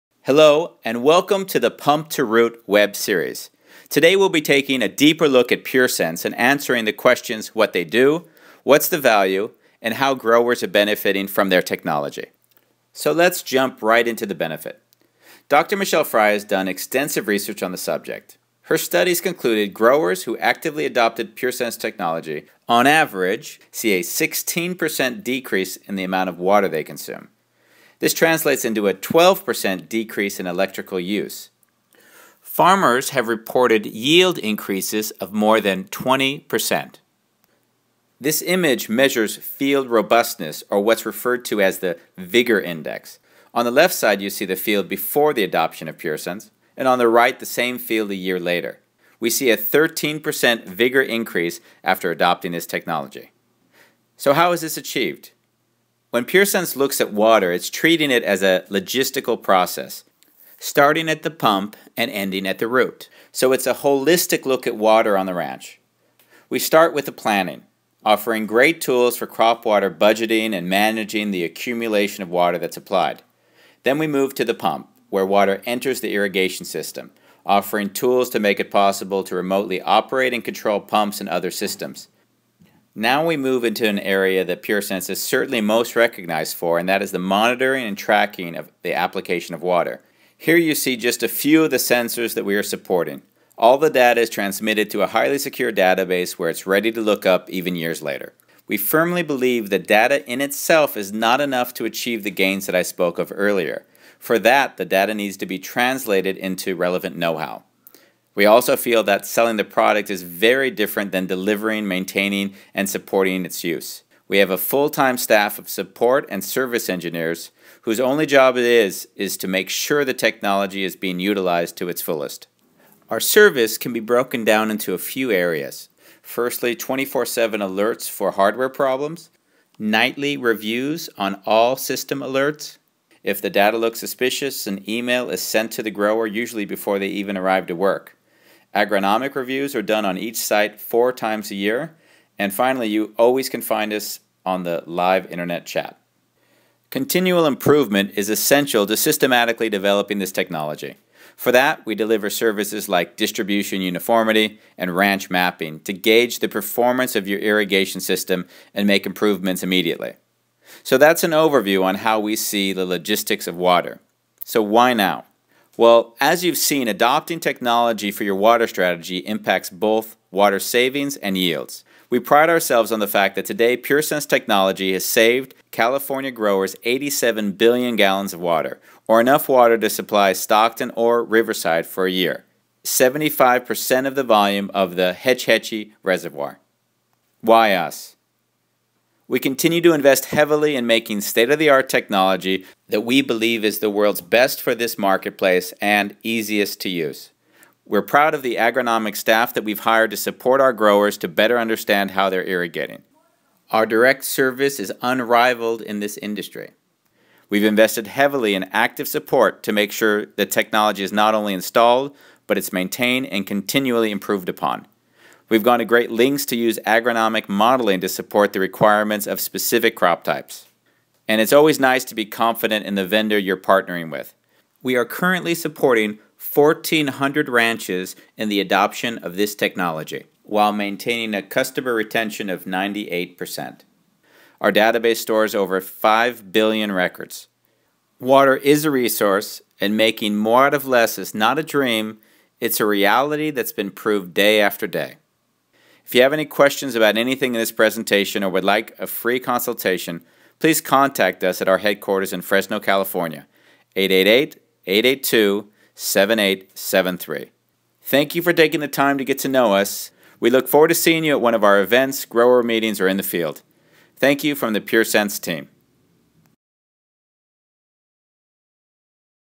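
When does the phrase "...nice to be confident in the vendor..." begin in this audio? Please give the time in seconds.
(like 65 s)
221 s.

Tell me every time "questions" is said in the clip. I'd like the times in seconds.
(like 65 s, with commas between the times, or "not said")
6 s, 246 s.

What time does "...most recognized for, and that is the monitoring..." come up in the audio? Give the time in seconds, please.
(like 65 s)
85 s.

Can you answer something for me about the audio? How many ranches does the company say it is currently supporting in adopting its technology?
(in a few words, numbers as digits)
1,400.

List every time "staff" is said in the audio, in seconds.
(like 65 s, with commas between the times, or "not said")
115 s, 199 s.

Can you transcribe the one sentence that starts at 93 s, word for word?
All the data is transmitted to a highly secure database where it's ready to look up even years later.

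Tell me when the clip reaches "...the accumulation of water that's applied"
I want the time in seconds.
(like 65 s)
71 s.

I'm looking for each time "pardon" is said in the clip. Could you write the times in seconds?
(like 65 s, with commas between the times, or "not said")
not said.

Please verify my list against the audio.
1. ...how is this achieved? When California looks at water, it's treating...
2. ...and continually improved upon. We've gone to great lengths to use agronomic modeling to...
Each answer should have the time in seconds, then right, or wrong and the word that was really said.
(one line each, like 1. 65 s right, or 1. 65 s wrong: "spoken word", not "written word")
1. 54 s wrong: "PureSense", not "California"
2. 213 s right.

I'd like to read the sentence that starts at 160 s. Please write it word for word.
So that's an overview on how we see the logistics of water.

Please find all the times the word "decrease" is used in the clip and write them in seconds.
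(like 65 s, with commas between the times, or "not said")
25 s, 29 s.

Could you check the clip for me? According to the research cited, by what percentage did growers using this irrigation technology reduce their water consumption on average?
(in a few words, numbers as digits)
16%.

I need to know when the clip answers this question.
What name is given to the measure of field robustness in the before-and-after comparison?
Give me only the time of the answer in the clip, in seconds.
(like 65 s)
42 s.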